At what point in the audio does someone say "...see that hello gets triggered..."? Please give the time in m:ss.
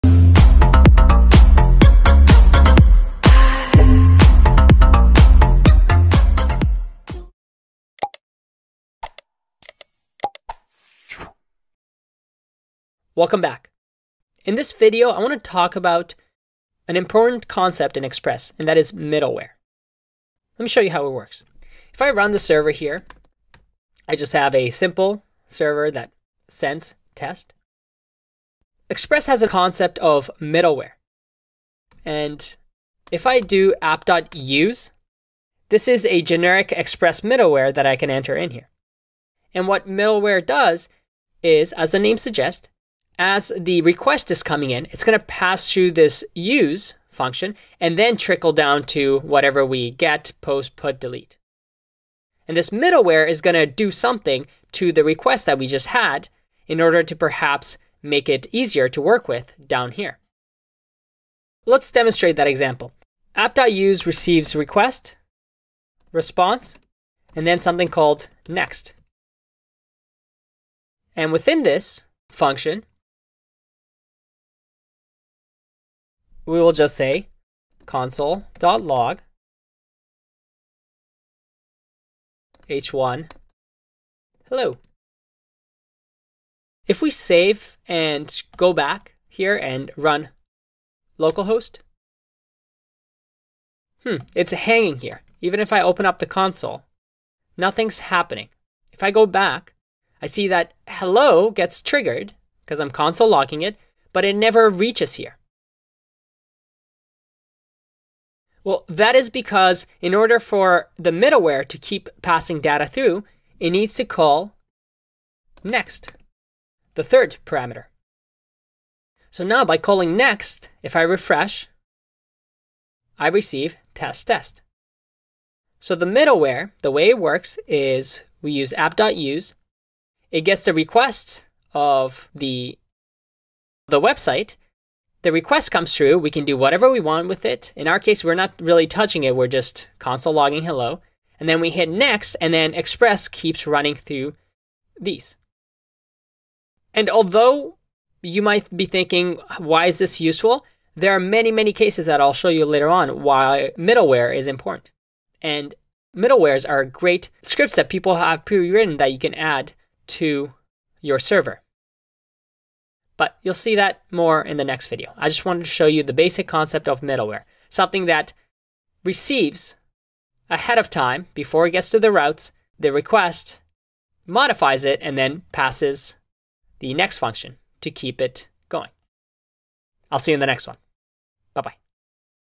1:40.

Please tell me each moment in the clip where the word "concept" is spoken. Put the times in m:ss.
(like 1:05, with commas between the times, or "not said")
0:17, 0:29, 2:46.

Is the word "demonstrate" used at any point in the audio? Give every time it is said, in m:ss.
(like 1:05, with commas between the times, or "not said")
1:01.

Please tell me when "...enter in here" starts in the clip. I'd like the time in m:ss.
0:38.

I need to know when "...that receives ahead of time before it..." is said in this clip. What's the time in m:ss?
2:48.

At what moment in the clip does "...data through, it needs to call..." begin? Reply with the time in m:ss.
1:52.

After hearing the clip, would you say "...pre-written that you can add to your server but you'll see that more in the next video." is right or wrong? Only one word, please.
right.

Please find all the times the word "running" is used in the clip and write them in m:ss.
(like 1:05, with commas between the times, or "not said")
2:23.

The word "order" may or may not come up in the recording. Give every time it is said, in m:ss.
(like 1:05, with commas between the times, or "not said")
0:56, 1:50.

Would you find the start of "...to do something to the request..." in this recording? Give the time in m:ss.
0:53.